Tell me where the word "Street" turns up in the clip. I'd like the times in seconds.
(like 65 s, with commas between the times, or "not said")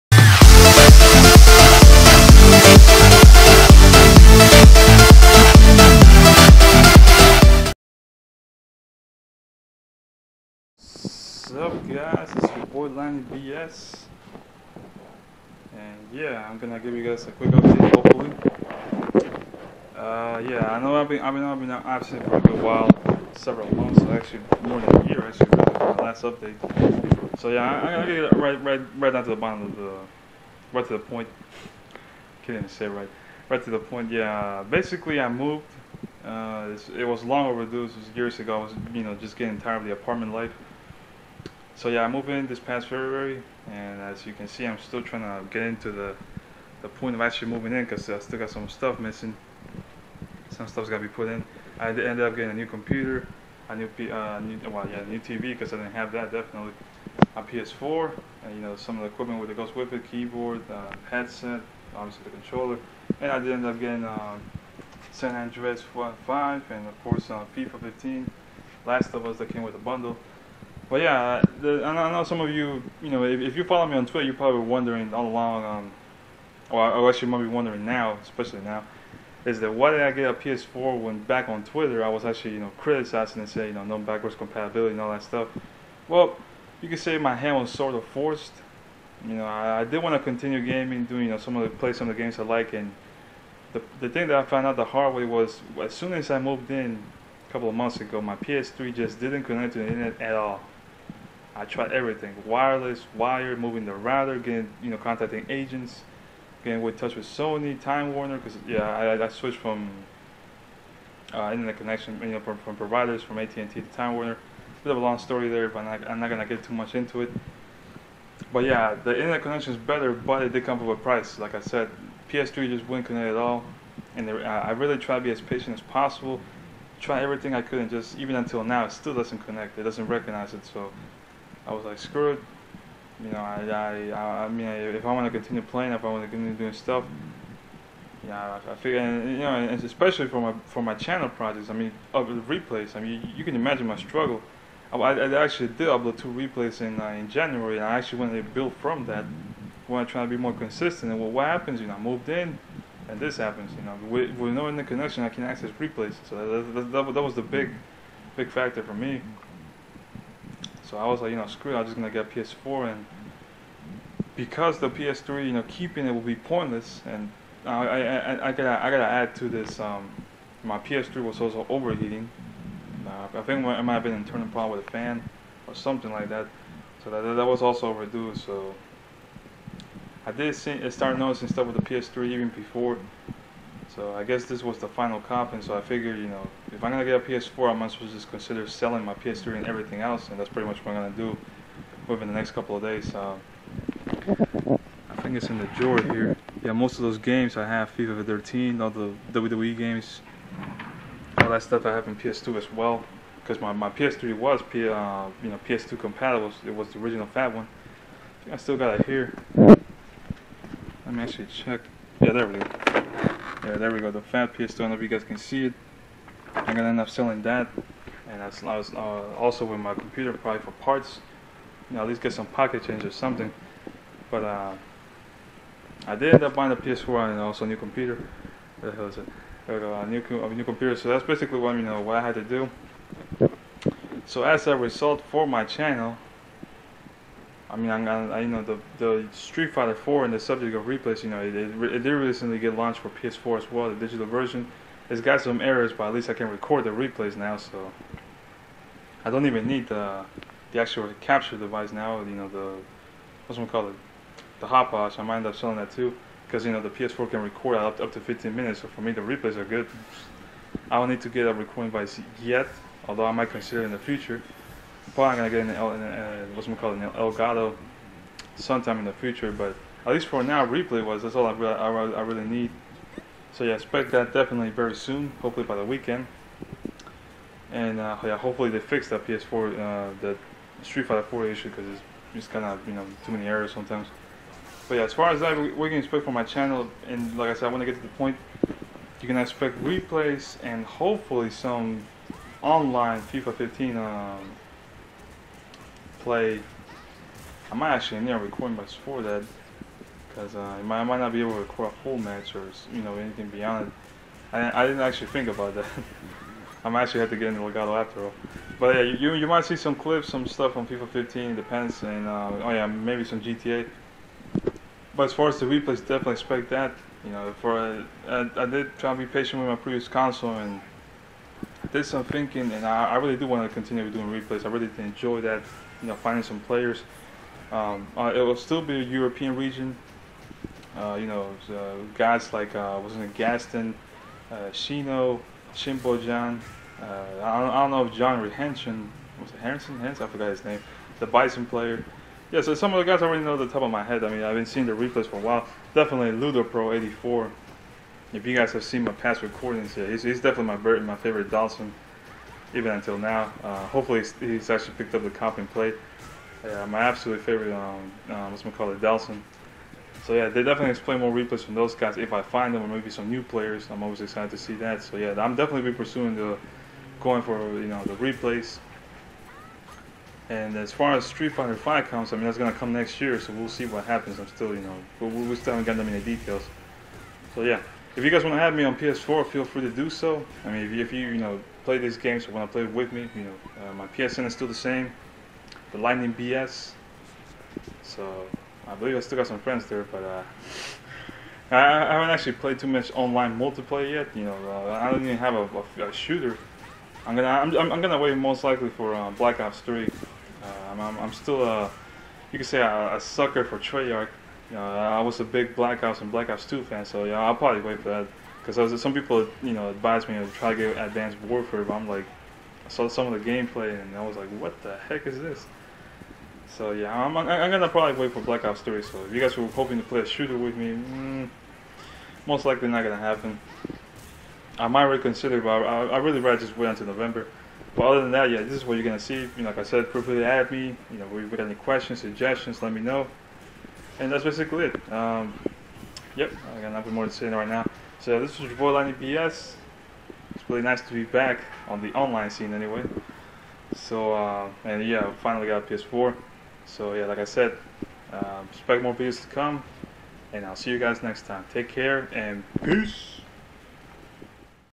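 239 s, 280 s, 371 s.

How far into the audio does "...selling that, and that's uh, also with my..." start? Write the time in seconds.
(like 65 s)
217 s.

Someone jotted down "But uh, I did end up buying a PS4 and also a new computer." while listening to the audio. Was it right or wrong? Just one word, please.
right.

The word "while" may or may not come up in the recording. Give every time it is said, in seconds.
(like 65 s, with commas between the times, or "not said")
22 s, 345 s.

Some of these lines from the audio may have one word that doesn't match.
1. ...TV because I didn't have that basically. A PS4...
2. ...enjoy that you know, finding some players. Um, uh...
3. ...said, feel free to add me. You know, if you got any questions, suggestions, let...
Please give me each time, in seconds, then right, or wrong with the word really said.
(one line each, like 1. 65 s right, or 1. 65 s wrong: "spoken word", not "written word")
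1. 55 s wrong: "definitely", not "basically"
2. 324 s right
3. 429 s right.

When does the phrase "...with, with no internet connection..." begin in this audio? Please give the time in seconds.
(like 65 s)
154 s.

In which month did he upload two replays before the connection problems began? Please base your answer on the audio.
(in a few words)
January.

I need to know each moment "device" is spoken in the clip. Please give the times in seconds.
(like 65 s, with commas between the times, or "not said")
251 s, 261 s.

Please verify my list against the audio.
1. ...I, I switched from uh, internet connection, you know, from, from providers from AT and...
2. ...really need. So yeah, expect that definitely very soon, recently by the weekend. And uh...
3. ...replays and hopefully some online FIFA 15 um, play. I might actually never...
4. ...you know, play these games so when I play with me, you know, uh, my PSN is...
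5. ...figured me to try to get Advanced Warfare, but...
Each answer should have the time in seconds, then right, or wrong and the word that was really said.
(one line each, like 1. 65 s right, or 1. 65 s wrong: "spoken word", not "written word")
1. 108 s right
2. 272 s wrong: "hopefully", not "recently"
3. 289 s right
4. 381 s right
5. 409 s wrong: "advised", not "figured".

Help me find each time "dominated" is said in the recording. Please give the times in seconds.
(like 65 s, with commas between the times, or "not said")
not said.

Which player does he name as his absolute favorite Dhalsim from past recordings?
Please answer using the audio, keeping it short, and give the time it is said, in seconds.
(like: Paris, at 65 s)
Ludo Pro 84, at 346 s.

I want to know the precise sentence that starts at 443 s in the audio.
So, uh, and yeah, finally got a PS4.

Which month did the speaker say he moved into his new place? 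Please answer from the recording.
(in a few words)
February.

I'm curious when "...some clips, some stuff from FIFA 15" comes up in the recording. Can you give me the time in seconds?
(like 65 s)
309 s.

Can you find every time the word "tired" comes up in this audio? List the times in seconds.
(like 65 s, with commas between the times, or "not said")
39 s.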